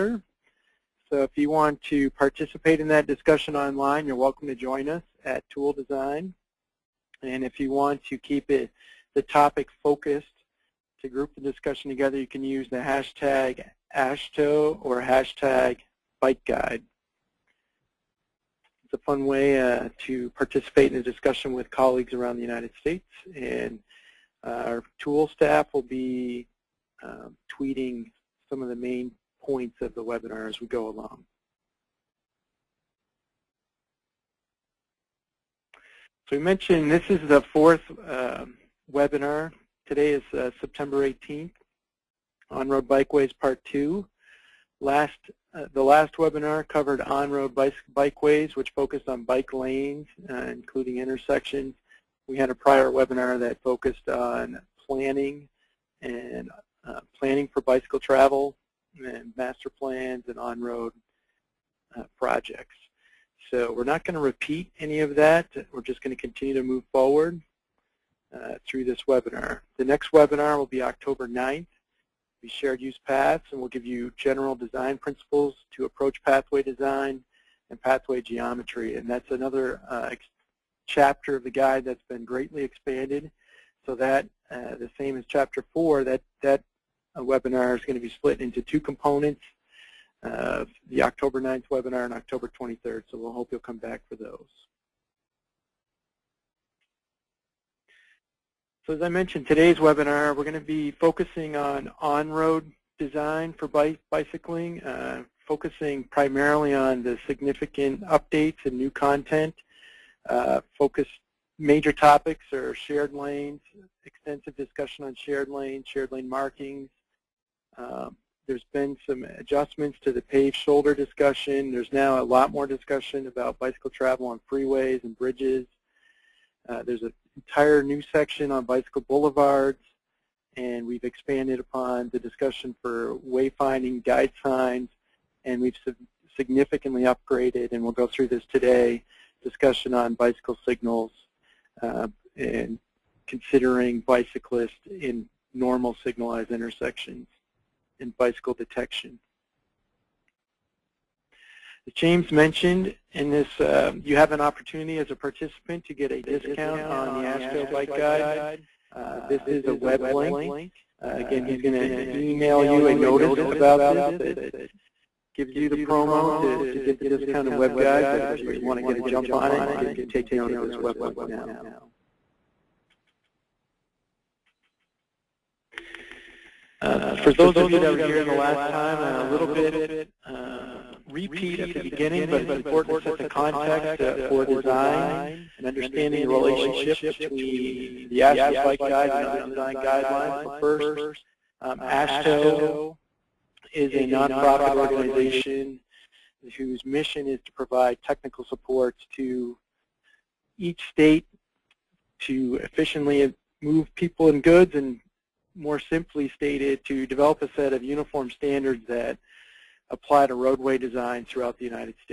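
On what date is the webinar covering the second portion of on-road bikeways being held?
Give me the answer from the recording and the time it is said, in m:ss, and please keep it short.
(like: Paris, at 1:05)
September 18, at 0:40.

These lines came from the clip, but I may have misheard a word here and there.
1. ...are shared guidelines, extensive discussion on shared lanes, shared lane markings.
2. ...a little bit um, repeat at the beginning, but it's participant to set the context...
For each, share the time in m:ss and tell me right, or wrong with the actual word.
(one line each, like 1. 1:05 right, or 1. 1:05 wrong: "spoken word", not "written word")
1. 1:52 wrong: "lanes", not "guidelines"
2. 2:58 wrong: "important", not "participant".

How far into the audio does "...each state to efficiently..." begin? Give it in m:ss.
3:20.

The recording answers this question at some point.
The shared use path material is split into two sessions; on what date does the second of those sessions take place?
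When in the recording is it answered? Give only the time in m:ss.
1:32.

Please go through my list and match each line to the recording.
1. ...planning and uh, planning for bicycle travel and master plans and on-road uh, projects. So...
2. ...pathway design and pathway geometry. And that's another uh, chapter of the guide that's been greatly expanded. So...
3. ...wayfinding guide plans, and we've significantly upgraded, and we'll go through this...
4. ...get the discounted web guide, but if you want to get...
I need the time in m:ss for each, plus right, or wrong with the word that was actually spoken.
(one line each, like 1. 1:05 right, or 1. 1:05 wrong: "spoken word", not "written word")
1. 0:54 right
2. 1:16 right
3. 2:13 wrong: "signs", not "plans"
4. 2:46 right.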